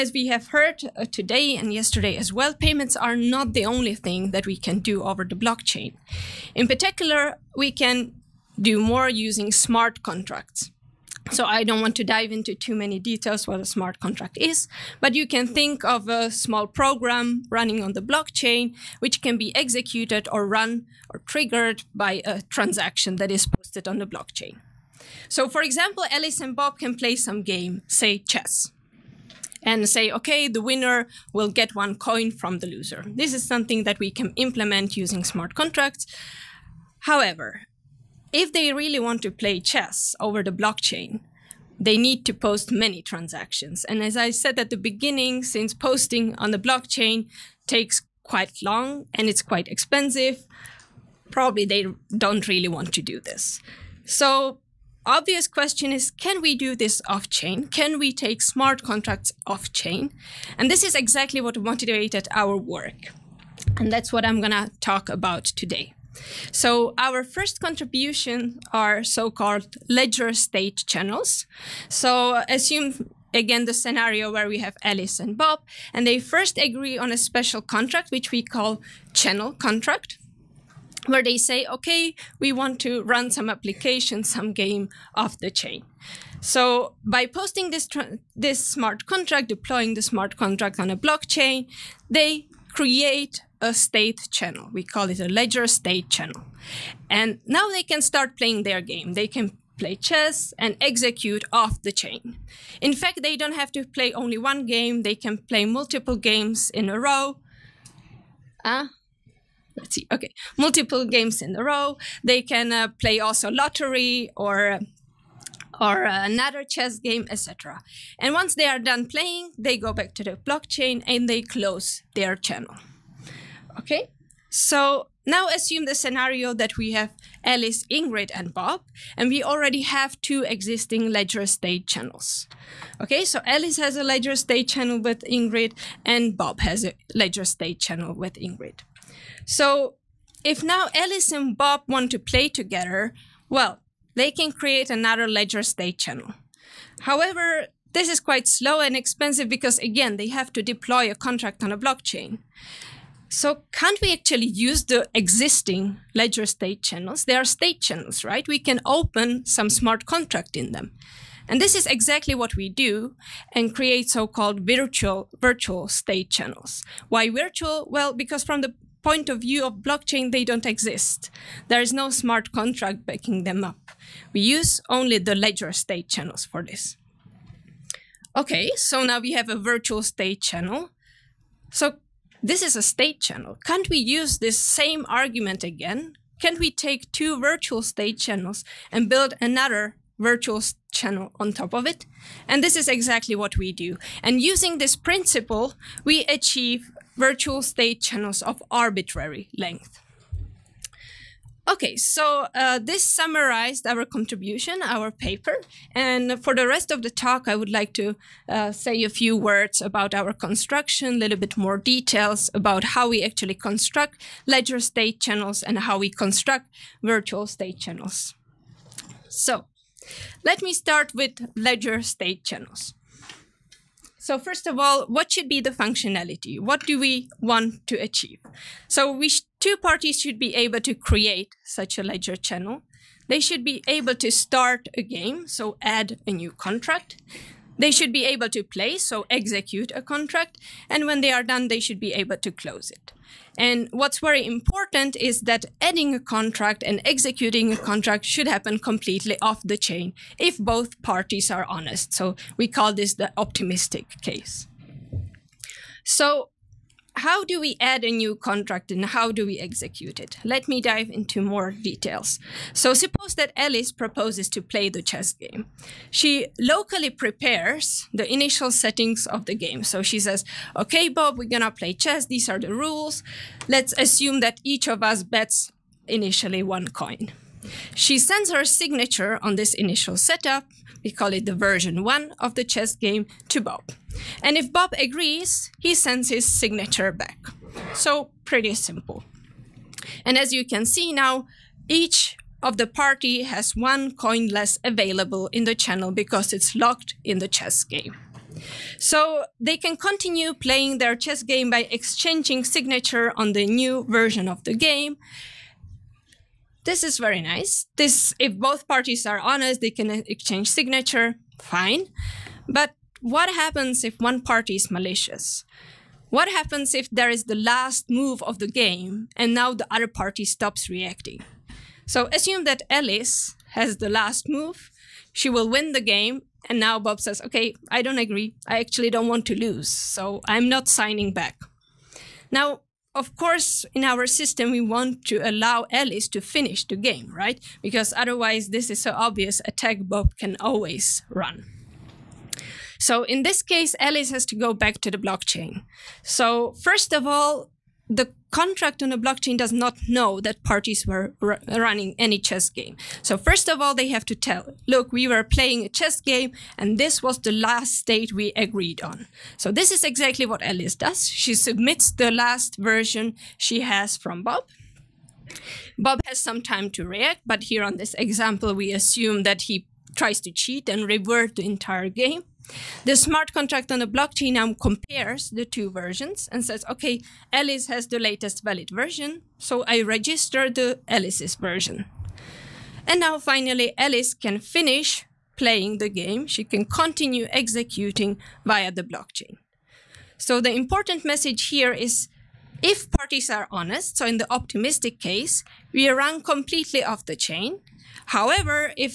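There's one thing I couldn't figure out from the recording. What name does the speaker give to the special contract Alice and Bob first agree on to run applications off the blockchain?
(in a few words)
Channel contract.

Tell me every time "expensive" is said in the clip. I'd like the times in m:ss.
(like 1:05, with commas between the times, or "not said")
0:49, 2:28.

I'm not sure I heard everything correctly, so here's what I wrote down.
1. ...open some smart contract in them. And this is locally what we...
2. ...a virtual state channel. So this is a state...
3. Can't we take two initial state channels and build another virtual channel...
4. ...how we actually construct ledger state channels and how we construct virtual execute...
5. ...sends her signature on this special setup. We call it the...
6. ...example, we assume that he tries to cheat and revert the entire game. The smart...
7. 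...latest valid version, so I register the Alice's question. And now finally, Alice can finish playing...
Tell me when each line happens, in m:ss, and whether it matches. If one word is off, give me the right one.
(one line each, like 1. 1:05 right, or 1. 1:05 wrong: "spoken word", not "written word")
1. 2:38 wrong: "exactly", not "locally"
2. 2:59 right
3. 3:06 wrong: "virtual", not "initial"
4. 3:32 wrong: "state", not "execute"
5. 4:38 wrong: "initial", not "special"
6. 6:08 right
7. 6:18 wrong: "version", not "question".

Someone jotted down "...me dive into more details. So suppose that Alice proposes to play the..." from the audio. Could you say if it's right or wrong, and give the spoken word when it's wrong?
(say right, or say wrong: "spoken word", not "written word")
right.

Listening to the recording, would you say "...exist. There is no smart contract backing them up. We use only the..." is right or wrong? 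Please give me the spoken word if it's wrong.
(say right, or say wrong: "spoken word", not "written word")
right.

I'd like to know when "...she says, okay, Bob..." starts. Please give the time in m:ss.
4:30.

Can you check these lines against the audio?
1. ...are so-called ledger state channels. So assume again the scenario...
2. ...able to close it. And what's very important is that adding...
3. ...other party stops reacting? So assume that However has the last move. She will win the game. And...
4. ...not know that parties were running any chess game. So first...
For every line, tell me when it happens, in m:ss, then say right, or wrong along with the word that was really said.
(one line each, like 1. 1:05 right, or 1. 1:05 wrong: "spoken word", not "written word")
1. 1:08 right
2. 4:02 right
3. 5:19 wrong: "Alice", not "However"
4. 5:49 right.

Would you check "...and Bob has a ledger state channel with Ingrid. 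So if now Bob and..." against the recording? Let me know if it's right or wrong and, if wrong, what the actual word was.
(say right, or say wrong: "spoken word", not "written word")
wrong: "Alice", not "Bob".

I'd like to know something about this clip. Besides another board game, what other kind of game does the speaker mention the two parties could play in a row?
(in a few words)
Lottery.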